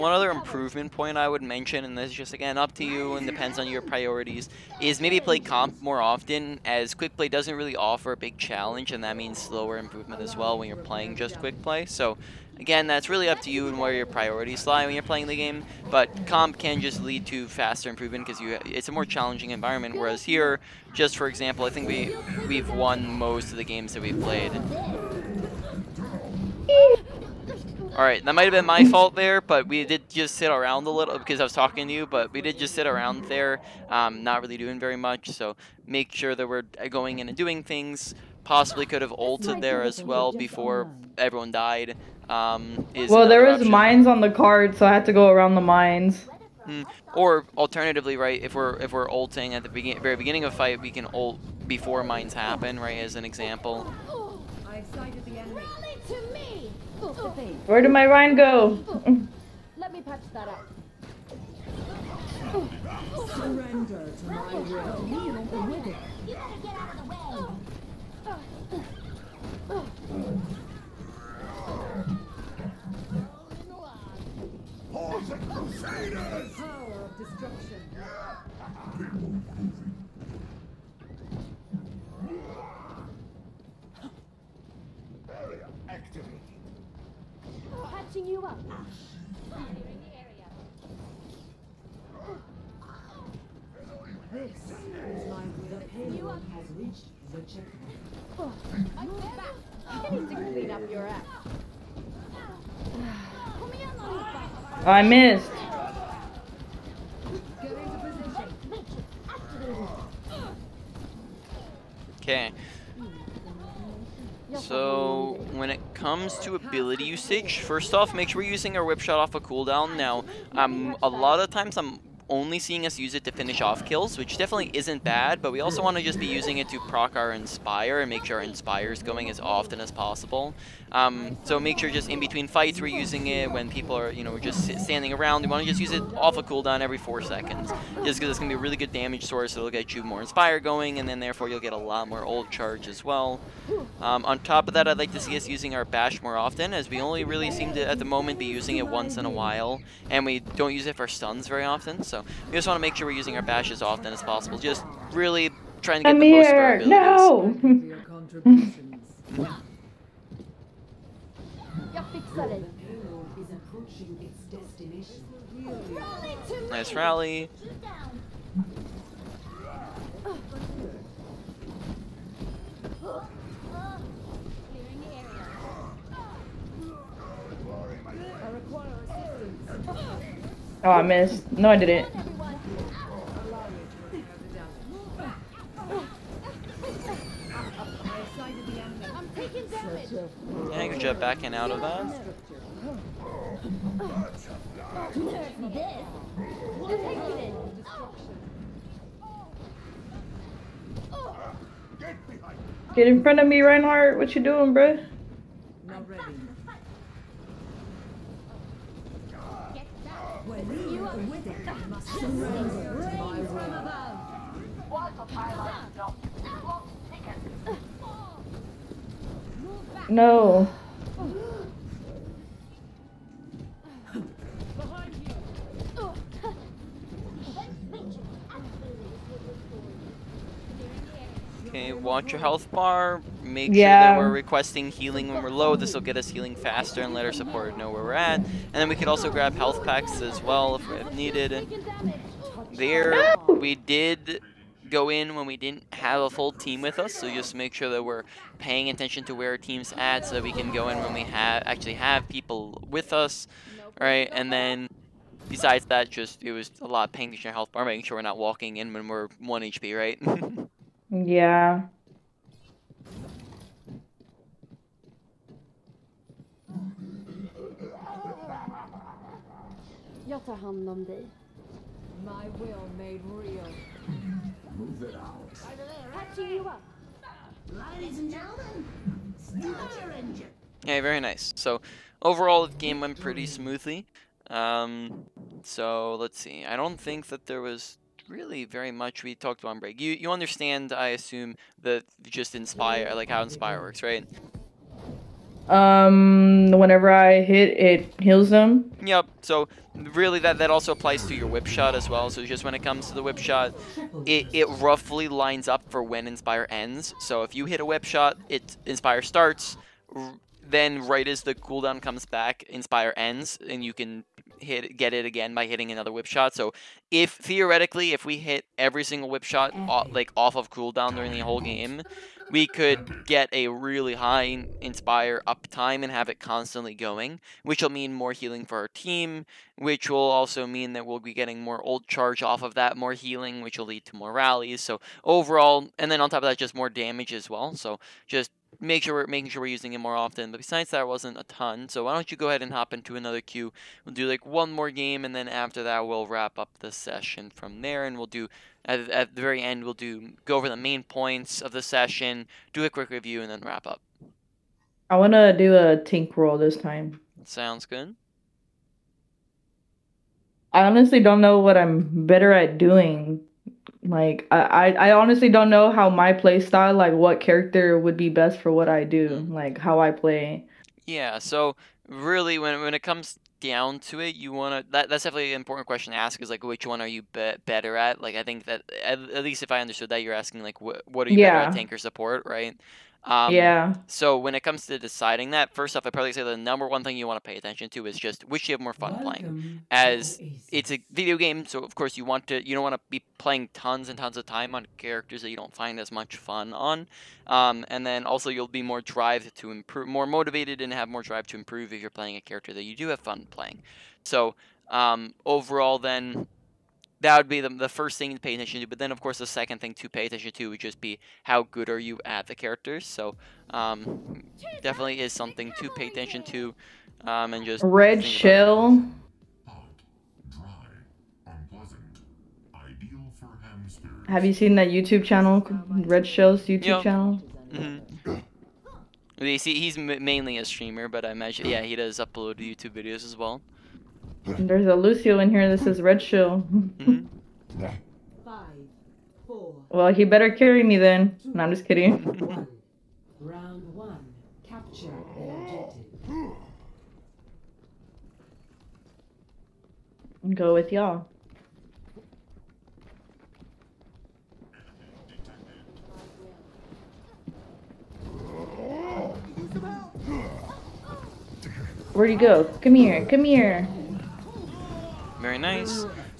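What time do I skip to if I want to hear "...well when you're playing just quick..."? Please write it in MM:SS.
00:10.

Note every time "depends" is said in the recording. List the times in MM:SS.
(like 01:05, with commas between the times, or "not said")
00:03.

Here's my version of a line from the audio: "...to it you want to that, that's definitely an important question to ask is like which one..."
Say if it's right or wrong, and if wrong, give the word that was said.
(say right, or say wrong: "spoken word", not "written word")
right.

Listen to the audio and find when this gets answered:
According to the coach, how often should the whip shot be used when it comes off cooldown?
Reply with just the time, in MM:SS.
02:16.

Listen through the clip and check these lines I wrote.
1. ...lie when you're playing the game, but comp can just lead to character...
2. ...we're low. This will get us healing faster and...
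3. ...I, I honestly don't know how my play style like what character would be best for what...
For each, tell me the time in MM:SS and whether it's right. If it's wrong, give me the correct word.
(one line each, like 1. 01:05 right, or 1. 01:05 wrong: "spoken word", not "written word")
1. 00:14 wrong: "faster", not "character"
2. 03:55 right
3. 06:04 right.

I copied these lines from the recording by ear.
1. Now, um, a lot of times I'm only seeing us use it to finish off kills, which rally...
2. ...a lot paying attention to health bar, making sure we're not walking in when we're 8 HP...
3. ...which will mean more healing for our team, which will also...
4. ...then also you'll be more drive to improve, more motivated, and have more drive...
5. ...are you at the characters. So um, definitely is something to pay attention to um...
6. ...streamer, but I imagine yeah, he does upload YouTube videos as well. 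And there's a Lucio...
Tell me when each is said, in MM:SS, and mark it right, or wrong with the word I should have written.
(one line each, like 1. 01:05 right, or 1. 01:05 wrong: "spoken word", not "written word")
1. 01:59 wrong: "definitely", not "rally"
2. 04:16 wrong: "1", not "8"
3. 05:27 right
4. 06:38 right
5. 06:51 right
6. 07:10 right.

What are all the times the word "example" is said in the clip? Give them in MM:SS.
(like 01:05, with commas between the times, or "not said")
00:21, 00:53.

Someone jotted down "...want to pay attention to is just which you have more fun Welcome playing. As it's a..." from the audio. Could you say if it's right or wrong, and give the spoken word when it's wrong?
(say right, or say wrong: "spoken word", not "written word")
right.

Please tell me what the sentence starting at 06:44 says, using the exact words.
So um, overall, then that would be the, the first thing to pay attention to.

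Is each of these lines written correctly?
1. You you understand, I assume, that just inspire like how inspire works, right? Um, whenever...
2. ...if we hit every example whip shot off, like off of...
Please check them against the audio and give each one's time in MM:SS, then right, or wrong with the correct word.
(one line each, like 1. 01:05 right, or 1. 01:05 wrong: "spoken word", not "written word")
1. 04:49 right
2. 05:18 wrong: "single", not "example".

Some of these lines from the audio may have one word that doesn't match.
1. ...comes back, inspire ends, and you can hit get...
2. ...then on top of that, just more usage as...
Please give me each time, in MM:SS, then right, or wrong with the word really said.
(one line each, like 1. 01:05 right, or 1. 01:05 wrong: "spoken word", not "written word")
1. 05:12 right
2. 05:36 wrong: "damage", not "usage".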